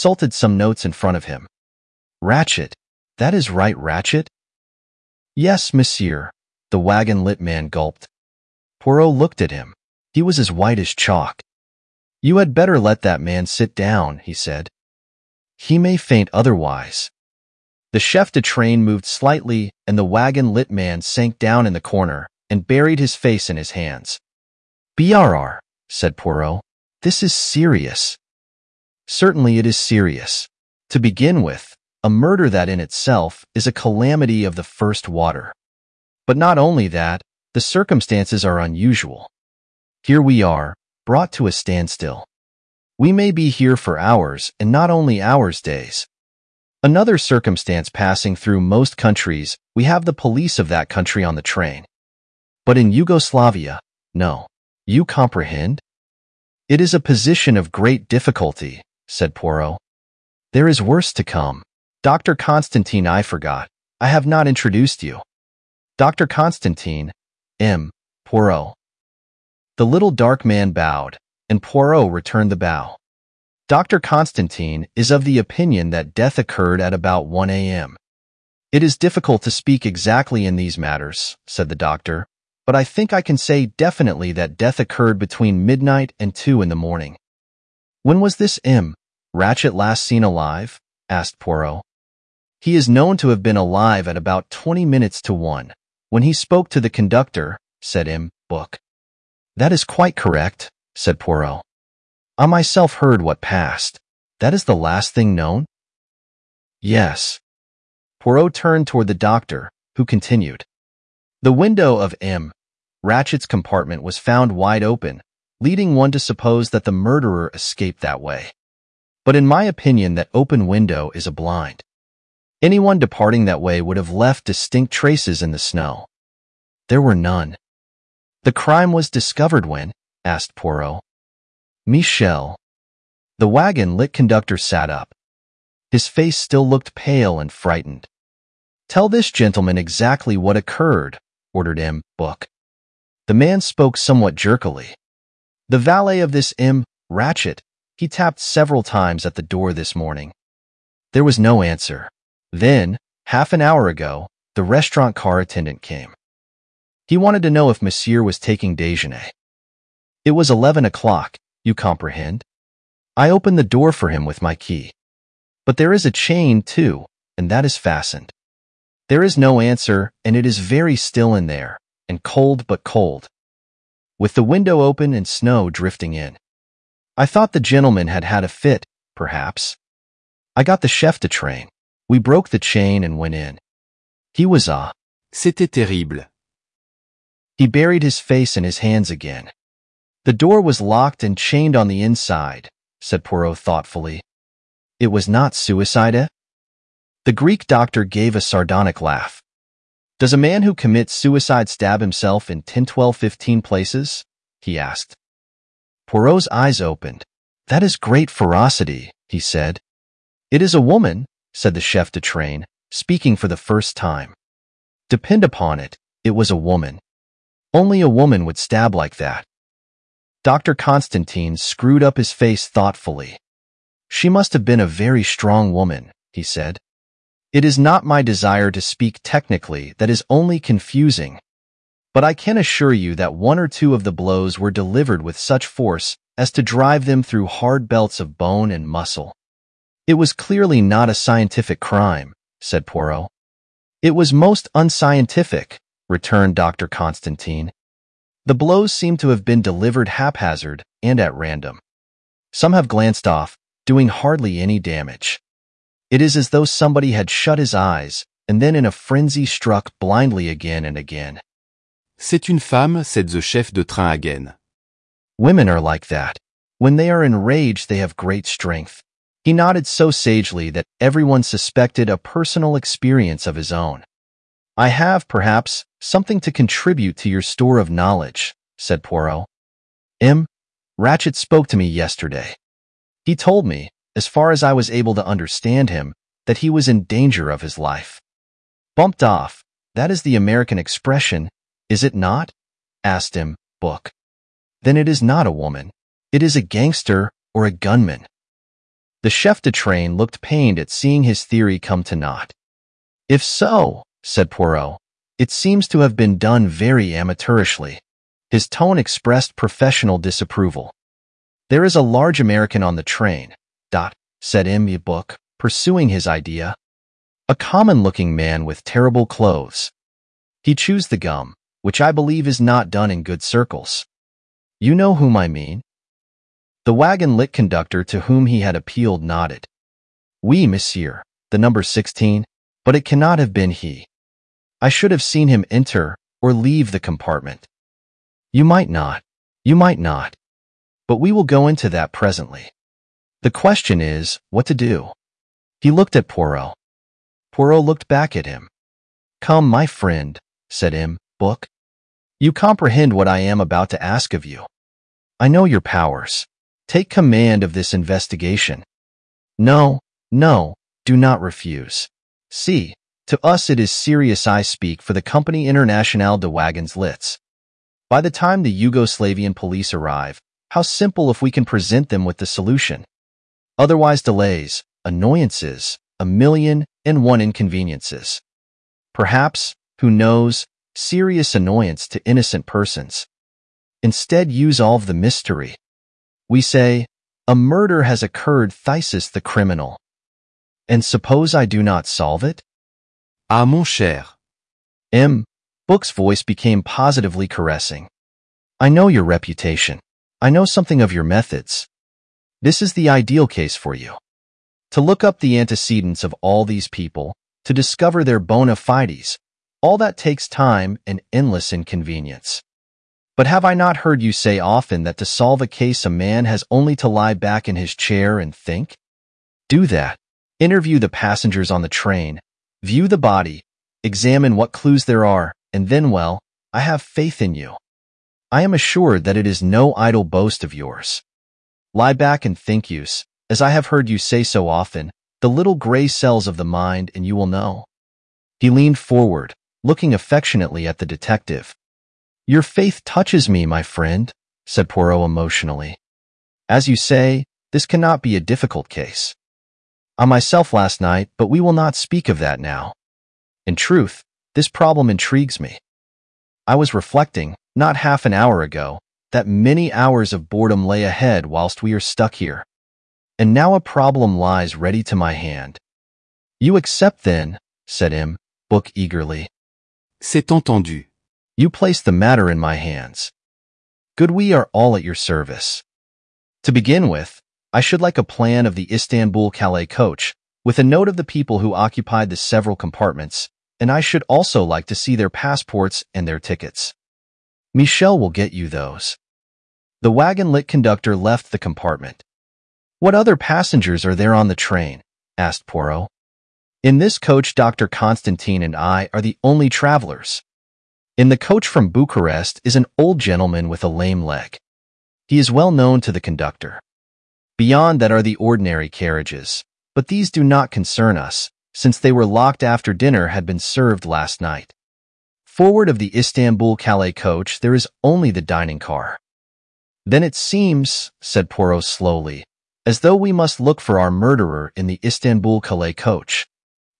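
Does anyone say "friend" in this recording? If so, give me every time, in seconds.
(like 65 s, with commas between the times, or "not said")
349 s, 443 s.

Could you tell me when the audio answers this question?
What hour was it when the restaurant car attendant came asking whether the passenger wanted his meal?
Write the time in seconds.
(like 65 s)
160 s.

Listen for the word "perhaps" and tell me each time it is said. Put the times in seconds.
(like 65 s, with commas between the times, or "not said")
179 s, 275 s, 379 s.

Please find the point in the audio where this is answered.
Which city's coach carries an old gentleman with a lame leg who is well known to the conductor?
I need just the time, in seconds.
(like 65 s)
501 s.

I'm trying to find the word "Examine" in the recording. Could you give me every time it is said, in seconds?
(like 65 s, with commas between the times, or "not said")
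424 s.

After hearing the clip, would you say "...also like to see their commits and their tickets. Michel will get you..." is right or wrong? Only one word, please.
wrong.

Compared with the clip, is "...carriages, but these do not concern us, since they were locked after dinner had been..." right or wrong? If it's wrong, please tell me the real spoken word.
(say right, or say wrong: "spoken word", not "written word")
right.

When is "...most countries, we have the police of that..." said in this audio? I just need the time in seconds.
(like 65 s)
48 s.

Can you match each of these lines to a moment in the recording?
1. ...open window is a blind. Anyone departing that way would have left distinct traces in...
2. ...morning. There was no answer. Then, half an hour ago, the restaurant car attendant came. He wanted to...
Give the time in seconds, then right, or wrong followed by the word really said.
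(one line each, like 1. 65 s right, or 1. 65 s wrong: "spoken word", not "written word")
1. 120 s right
2. 149 s right.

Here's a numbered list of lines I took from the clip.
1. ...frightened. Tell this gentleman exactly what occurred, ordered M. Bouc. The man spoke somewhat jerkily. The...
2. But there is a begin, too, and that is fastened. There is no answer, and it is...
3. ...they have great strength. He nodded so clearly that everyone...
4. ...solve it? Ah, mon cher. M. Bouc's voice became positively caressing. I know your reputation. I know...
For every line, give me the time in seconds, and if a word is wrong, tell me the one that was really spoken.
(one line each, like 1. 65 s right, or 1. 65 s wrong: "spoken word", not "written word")
1. 137 s right
2. 165 s wrong: "chain", not "begin"
3. 267 s wrong: "sagely", not "clearly"
4. 392 s right.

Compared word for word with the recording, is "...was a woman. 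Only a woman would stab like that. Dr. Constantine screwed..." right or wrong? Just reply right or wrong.
right.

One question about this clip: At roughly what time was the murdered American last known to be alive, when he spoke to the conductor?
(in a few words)
20 minutes to 1.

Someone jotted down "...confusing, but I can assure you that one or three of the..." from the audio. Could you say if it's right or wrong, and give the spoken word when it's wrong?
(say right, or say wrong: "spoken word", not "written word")
wrong: "two", not "three".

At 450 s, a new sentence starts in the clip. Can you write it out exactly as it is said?
On myself last night, but we will not speak of that now.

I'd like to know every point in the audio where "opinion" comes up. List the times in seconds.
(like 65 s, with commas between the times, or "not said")
75 s, 119 s.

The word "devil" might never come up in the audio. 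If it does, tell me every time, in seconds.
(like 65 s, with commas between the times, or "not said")
not said.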